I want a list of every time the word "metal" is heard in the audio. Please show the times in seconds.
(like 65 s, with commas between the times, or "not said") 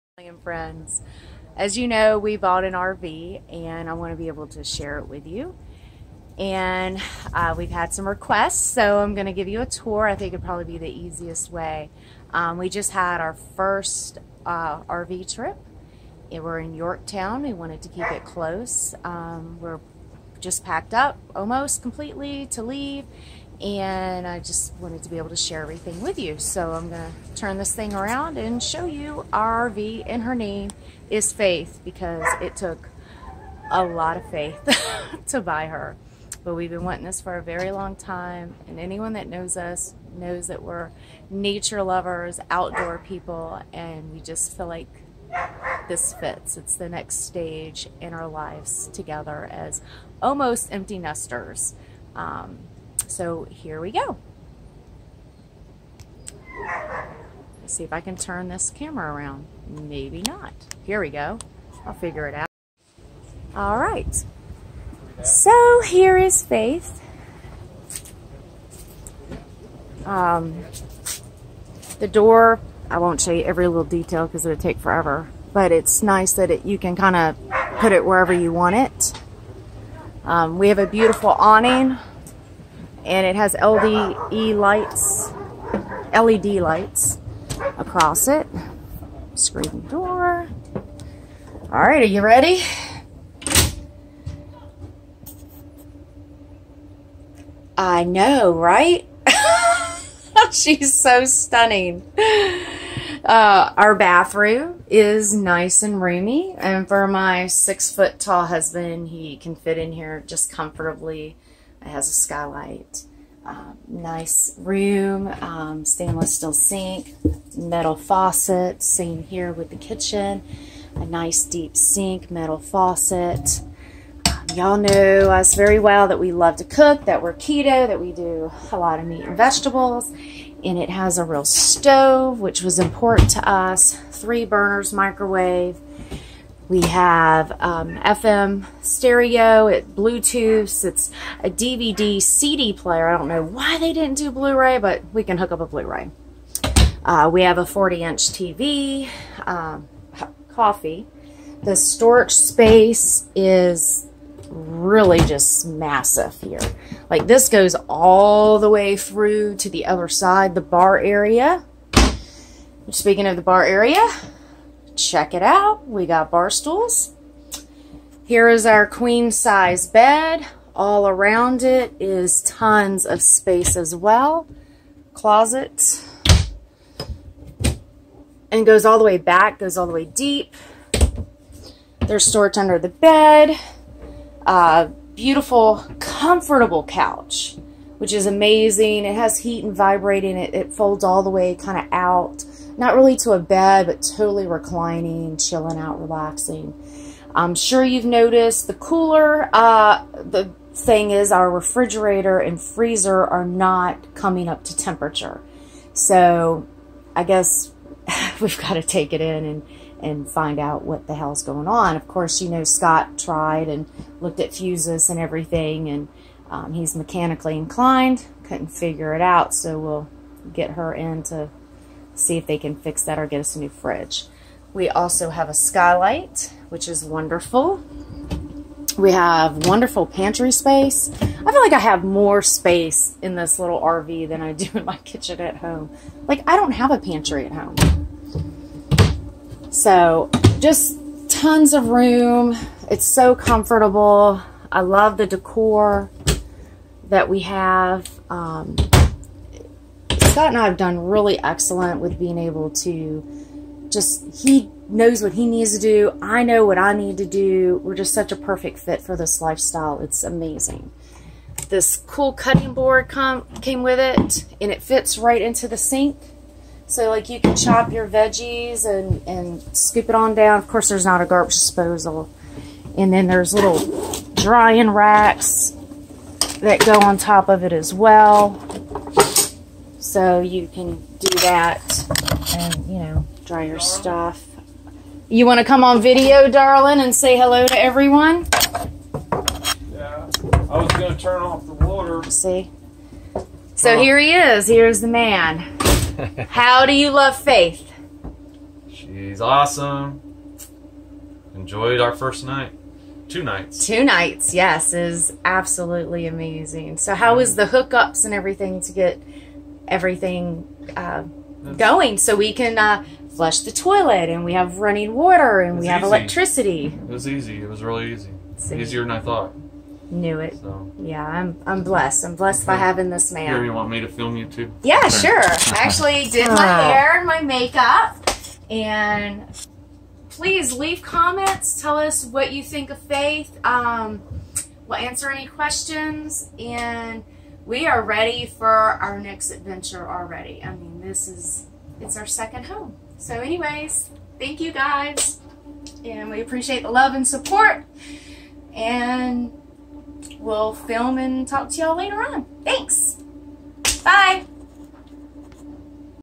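117 s, 122 s.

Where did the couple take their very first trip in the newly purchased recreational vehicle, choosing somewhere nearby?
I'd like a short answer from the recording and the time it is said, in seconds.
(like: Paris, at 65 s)
Yorktown, at 16 s.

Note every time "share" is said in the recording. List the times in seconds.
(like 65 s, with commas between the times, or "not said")
4 s, 25 s.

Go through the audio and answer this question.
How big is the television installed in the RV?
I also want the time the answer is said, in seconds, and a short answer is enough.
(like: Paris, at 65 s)
40-inch, at 147 s.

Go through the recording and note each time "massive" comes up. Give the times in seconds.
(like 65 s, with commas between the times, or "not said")
155 s.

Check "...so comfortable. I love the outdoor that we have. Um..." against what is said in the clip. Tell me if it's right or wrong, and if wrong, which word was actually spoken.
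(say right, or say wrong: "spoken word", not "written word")
wrong: "decor", not "outdoor".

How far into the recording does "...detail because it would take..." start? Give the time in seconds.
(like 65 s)
73 s.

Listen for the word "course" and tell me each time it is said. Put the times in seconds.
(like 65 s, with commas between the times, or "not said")
212 s, 270 s.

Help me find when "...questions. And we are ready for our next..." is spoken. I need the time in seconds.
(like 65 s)
335 s.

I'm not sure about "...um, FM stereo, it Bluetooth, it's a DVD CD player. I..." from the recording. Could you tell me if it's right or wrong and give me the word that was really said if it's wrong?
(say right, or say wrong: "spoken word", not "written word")
right.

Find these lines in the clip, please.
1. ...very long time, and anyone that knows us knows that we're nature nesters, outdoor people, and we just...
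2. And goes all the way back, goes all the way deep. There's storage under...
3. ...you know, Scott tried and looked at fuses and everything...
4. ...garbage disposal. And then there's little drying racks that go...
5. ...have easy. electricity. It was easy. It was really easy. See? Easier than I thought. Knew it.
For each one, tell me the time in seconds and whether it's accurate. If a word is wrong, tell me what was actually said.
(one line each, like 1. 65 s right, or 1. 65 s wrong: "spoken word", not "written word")
1. 37 s wrong: "lovers", not "nesters"
2. 178 s right
3. 212 s right
4. 271 s right
5. 315 s right.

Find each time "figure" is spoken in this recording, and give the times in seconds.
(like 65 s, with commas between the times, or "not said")
61 s, 218 s.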